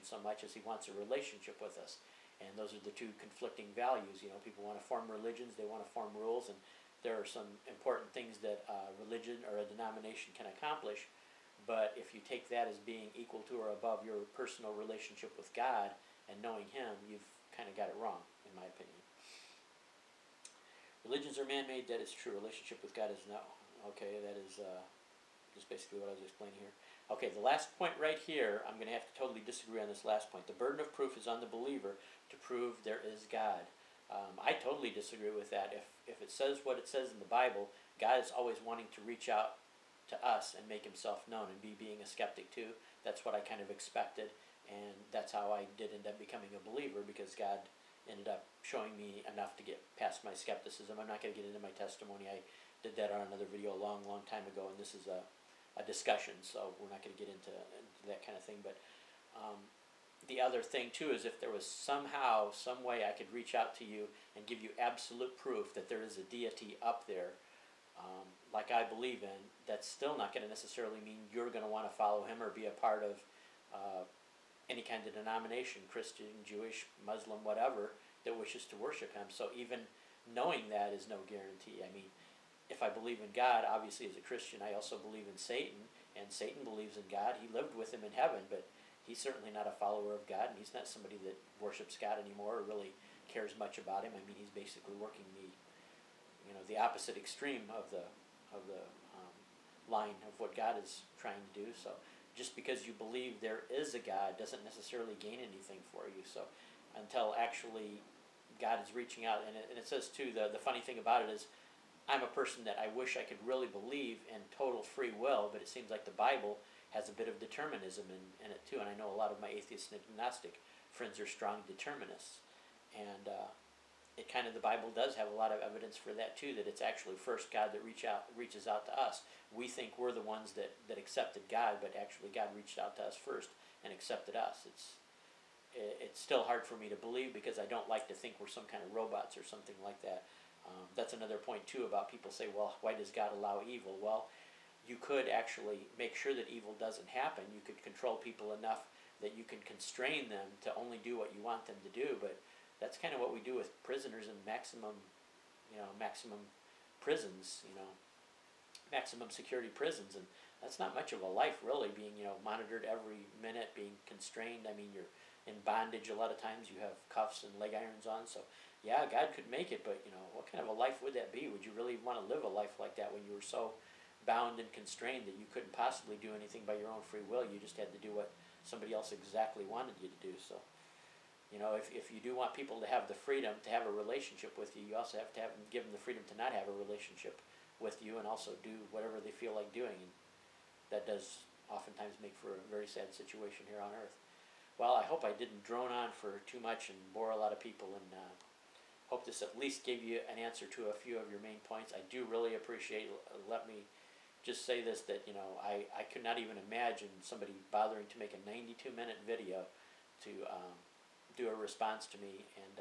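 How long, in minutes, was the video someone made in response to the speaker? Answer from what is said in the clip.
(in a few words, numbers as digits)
92.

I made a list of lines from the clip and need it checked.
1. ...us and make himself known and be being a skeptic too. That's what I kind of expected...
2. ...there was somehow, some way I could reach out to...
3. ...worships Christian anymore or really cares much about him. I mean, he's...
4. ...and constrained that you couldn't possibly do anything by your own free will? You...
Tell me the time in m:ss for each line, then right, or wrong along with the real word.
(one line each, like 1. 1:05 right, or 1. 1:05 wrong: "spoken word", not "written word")
1. 0:40 right
2. 1:01 right
3. 1:31 wrong: "God", not "Christian"
4. 2:54 right.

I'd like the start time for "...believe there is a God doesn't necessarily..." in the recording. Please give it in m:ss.
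1:42.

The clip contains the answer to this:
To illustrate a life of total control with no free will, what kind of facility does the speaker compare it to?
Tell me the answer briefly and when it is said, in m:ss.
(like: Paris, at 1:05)
maximum security prisons, at 2:38.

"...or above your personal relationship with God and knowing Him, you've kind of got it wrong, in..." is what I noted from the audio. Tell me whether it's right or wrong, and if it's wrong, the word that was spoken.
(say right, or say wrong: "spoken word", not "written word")
right.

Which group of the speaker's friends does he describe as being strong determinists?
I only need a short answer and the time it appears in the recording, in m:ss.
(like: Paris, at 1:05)
atheist and agnostic friends, at 1:59.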